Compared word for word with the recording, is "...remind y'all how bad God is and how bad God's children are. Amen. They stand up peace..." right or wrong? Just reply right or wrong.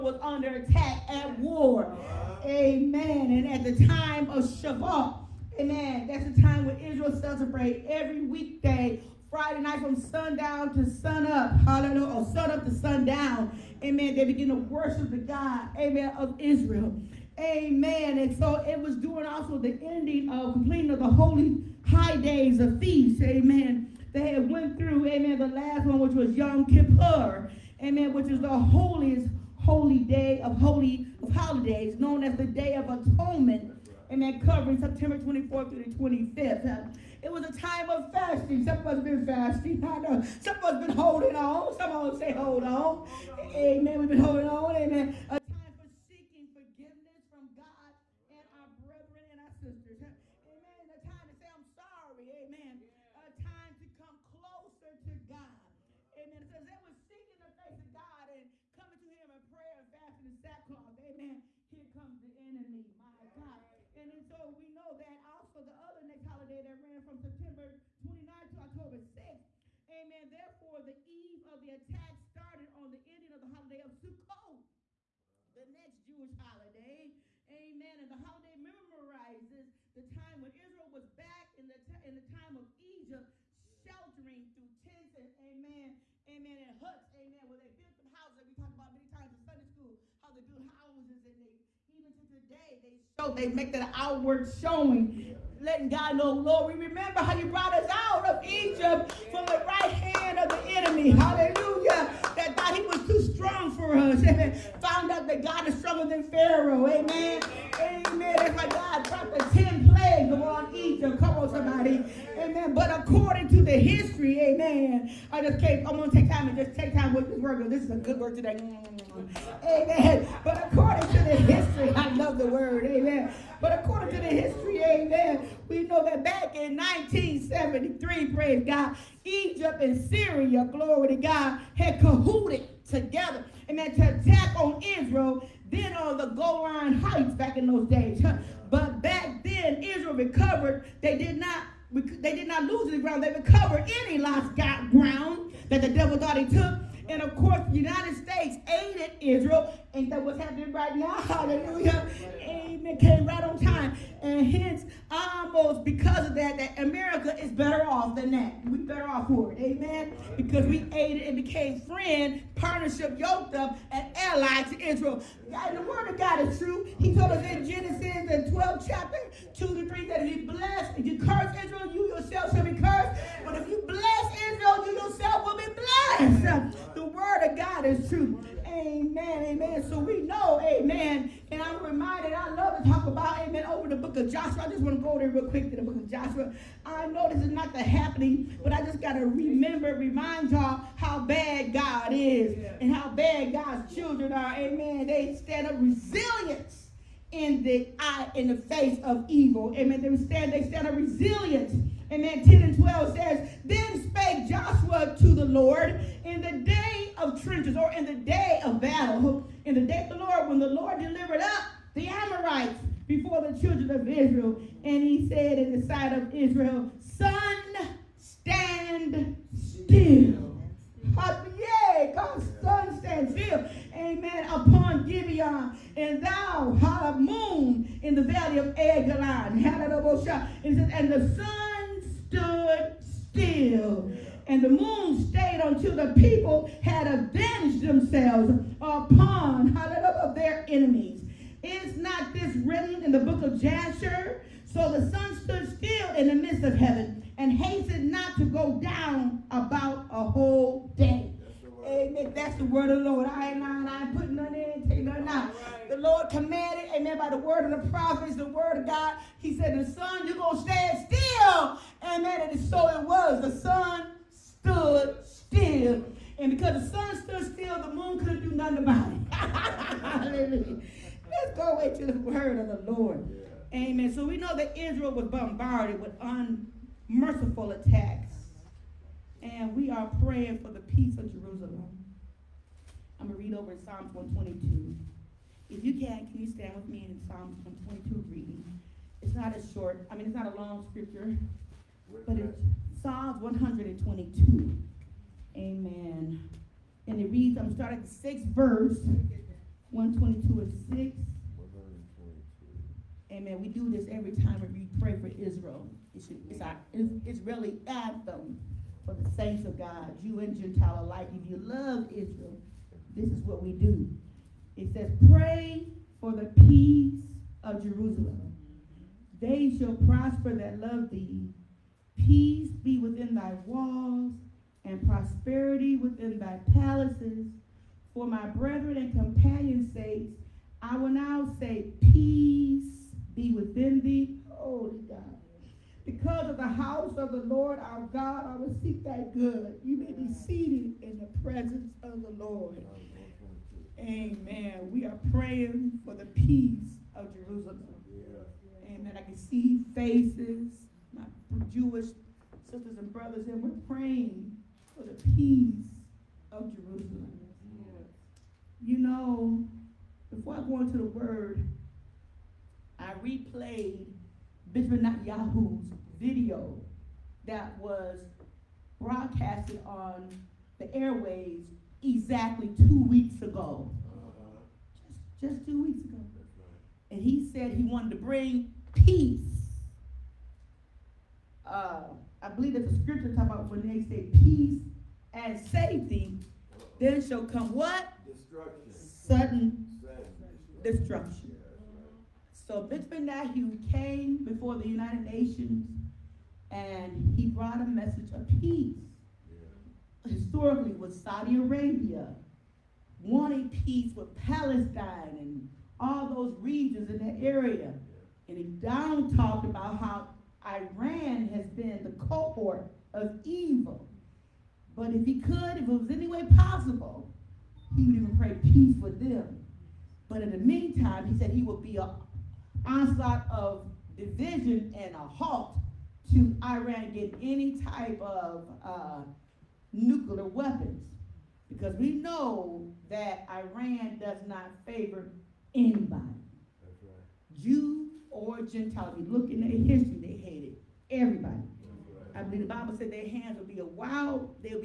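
wrong.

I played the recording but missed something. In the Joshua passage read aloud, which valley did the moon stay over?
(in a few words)
Valley of Eglon.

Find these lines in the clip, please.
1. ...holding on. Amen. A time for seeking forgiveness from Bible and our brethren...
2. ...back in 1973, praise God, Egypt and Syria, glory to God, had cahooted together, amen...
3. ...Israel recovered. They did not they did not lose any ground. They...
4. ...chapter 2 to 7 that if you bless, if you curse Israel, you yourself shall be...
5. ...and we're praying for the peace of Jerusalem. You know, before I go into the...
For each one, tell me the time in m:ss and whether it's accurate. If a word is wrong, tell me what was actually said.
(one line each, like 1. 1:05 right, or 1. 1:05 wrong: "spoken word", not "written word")
1. 0:44 wrong: "God", not "Bible"
2. 2:06 right
3. 2:19 right
4. 2:48 wrong: "3", not "7"
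5. 5:53 right.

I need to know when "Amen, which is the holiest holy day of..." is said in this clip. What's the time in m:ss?
0:27.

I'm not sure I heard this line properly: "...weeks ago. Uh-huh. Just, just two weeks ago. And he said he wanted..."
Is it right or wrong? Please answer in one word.
right.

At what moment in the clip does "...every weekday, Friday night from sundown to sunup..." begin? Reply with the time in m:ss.
0:07.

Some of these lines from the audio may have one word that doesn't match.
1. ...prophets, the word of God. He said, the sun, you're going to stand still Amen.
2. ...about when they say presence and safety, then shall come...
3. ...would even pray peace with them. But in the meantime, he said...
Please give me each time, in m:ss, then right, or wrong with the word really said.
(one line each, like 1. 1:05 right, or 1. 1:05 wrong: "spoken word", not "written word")
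1. 4:17 right
2. 6:23 wrong: "peace", not "presence"
3. 6:58 right.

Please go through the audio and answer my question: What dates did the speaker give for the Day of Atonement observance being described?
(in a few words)
September 24-25.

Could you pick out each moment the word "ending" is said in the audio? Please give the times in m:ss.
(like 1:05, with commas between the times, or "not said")
0:19, 1:13.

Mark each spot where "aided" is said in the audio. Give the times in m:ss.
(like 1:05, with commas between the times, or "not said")
2:28, 2:40.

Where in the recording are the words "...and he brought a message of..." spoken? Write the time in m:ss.
6:36.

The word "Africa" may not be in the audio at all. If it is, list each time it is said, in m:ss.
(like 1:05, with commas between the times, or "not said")
not said.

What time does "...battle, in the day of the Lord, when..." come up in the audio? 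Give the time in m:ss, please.
3:28.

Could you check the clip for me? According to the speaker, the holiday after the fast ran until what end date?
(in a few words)
October 6.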